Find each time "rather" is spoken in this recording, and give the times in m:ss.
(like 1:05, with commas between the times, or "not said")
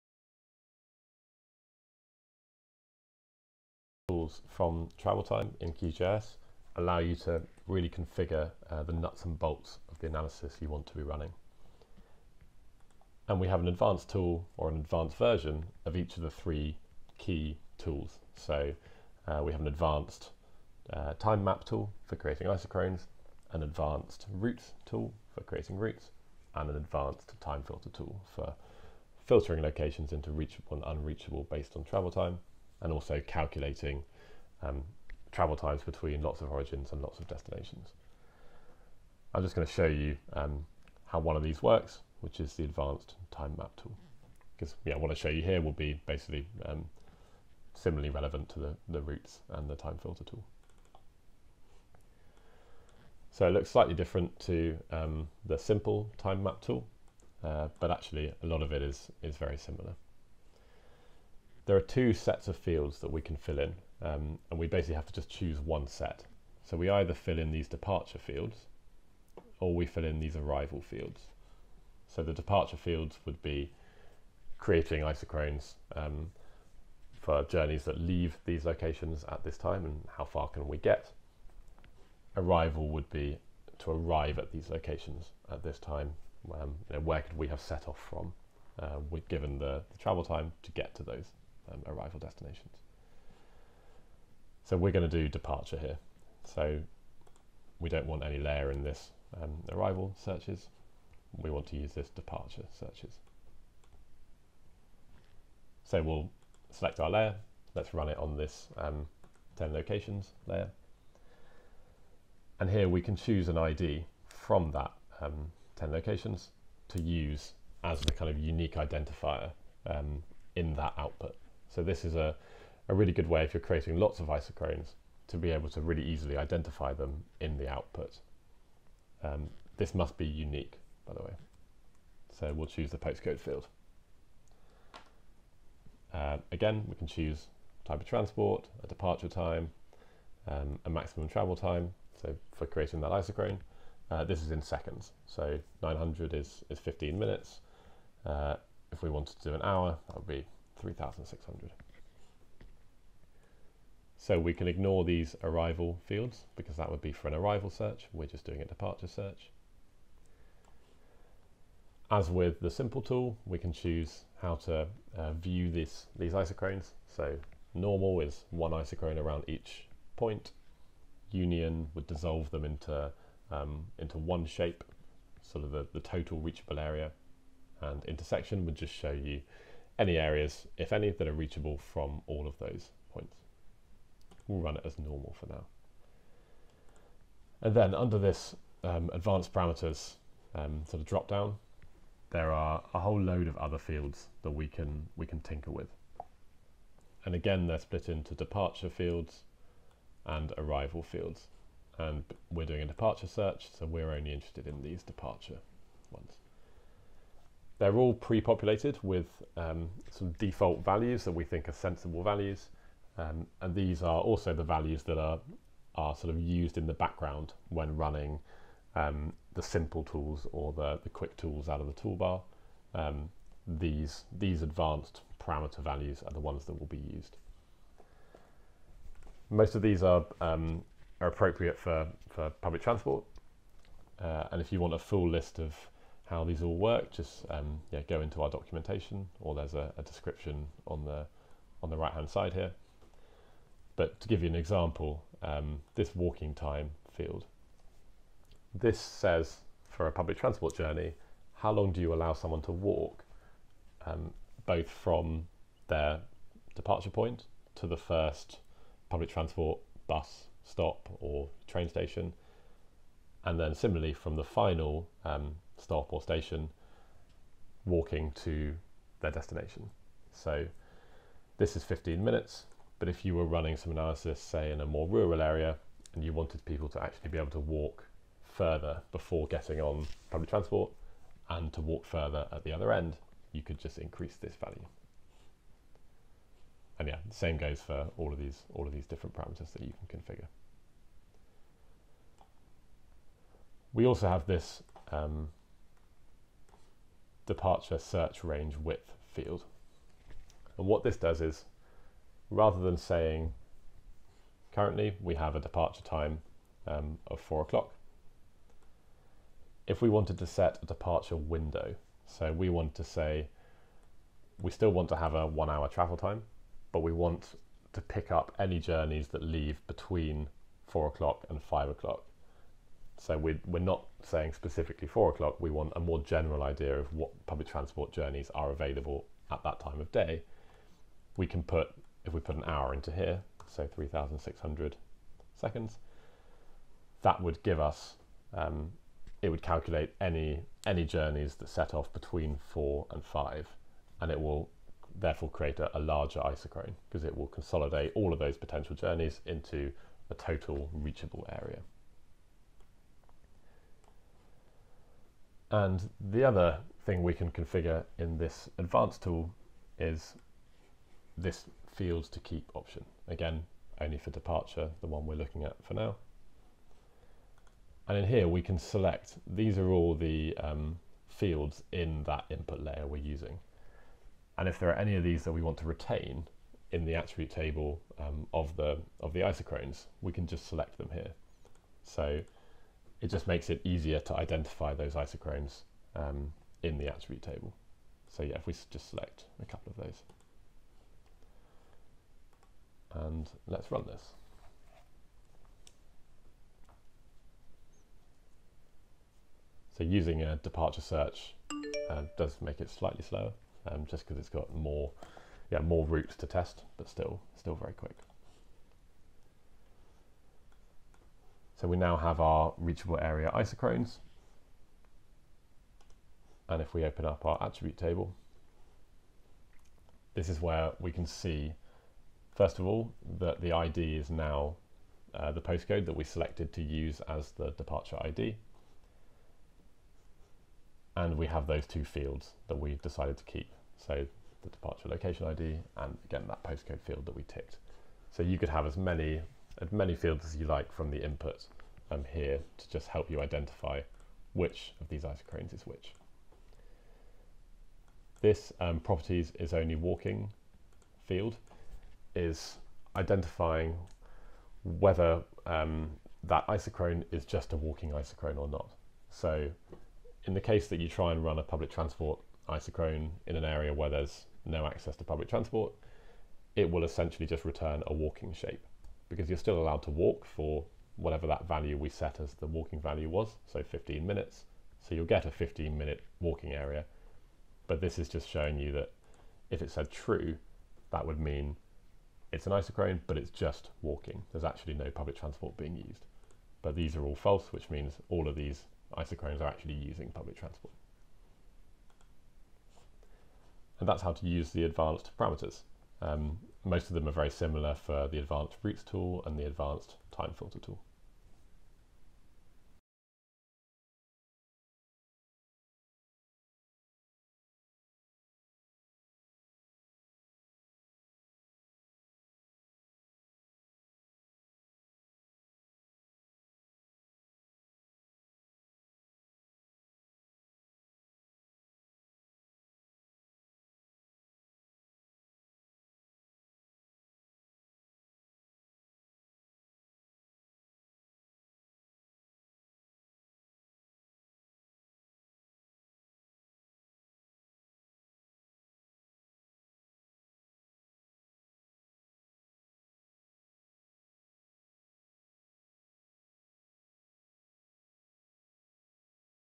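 5:02.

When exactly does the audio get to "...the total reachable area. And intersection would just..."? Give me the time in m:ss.
2:55.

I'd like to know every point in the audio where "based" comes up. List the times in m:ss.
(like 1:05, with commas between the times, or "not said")
0:31.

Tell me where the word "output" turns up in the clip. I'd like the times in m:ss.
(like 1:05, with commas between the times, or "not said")
2:00, 2:07.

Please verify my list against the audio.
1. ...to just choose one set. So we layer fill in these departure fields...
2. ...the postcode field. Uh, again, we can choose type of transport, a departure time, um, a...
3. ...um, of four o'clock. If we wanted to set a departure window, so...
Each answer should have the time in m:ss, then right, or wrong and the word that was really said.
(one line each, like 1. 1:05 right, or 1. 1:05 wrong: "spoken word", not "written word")
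1. 1:05 wrong: "either", not "layer"
2. 2:12 right
3. 5:06 right.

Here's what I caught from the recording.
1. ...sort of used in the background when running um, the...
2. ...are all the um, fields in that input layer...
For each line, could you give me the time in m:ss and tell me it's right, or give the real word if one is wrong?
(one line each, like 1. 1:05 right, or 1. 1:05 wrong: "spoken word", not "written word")
1. 3:36 right
2. 6:09 right.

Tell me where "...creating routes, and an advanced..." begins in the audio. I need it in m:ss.
0:25.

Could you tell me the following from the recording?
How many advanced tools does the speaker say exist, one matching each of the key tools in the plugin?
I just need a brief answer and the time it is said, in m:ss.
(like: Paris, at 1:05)
3, at 0:16.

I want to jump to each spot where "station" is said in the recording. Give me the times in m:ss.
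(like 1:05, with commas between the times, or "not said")
4:21, 4:26.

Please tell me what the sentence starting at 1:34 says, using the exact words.
So we're going to do departure here.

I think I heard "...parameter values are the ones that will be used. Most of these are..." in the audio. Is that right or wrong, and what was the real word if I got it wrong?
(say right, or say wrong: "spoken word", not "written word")
right.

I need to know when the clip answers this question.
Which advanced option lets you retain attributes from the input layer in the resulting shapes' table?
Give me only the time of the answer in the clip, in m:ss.
6:02.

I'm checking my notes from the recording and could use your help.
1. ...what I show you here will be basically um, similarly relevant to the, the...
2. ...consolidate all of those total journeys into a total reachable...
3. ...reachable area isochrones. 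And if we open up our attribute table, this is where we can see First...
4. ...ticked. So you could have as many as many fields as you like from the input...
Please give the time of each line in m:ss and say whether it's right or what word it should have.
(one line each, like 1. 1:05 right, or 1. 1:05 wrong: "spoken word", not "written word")
1. 0:44 right
2. 5:47 wrong: "potential", not "total"
3. 6:52 right
4. 7:17 right.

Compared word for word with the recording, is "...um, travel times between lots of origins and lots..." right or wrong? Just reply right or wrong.
right.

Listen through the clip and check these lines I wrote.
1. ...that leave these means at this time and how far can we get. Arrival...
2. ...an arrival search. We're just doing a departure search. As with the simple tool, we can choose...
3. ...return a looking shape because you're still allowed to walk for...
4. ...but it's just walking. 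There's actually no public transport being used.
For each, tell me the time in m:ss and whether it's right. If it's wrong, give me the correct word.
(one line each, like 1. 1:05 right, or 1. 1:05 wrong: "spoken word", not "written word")
1. 1:17 wrong: "locations", not "means"
2. 2:37 right
3. 7:47 wrong: "walking", not "looking"
4. 8:03 right.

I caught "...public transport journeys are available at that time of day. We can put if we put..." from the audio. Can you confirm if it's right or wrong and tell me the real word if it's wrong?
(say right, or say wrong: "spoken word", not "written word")
right.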